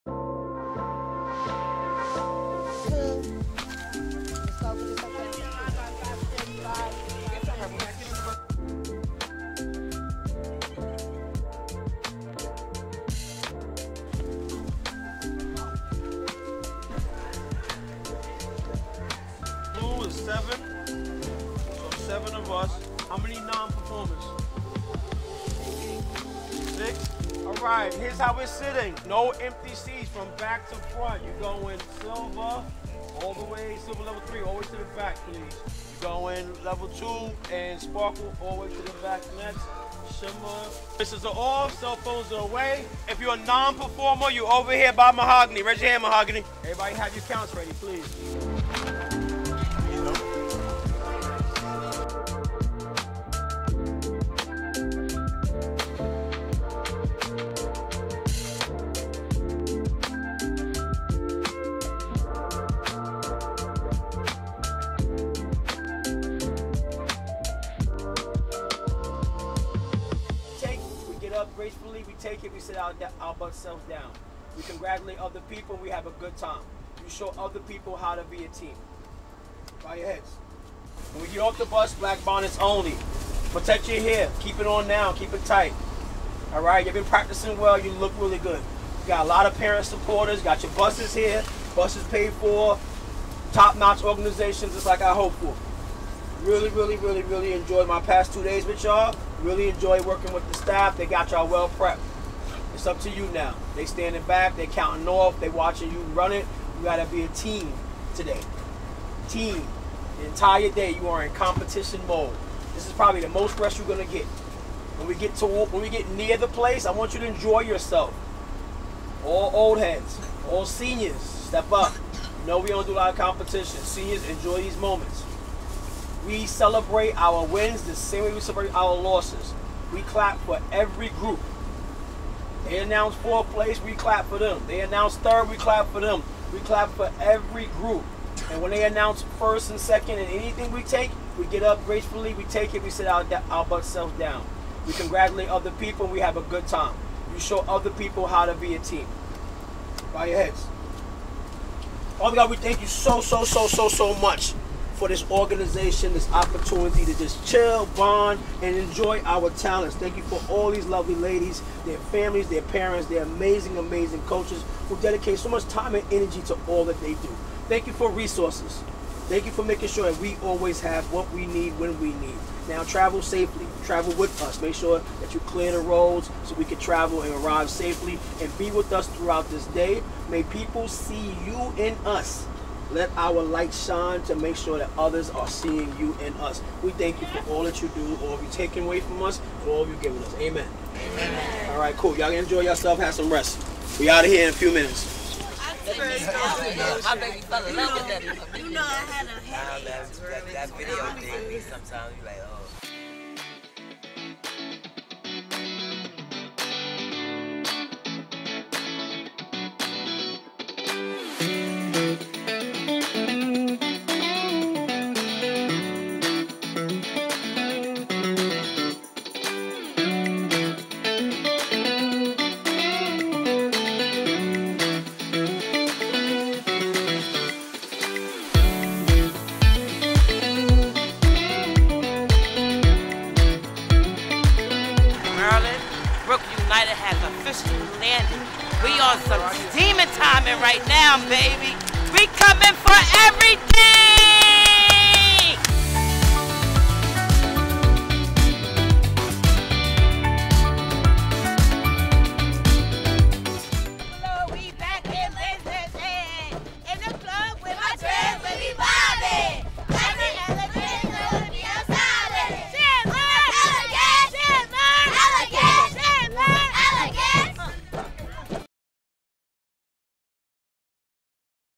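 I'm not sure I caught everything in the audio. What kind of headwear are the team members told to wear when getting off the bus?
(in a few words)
black bonnets.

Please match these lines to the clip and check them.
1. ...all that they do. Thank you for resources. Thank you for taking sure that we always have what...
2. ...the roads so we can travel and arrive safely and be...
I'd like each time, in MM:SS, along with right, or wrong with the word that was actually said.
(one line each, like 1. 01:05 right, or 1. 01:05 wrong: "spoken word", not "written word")
1. 02:46 wrong: "making", not "taking"
2. 02:55 right.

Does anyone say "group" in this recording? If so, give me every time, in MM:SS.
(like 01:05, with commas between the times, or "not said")
02:11, 02:17.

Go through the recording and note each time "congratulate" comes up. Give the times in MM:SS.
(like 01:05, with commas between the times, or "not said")
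01:14, 02:24.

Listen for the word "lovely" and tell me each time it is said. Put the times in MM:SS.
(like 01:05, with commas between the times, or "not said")
02:40.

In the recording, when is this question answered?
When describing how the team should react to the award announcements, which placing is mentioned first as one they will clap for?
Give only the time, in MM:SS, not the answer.
02:13.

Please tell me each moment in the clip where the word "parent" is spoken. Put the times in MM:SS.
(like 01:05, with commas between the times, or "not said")
01:29, 02:42.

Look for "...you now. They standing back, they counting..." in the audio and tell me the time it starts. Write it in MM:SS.
01:43.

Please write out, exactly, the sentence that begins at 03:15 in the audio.
You know, you know I had a headache.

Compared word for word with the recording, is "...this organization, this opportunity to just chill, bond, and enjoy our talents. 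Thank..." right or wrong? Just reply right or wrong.
right.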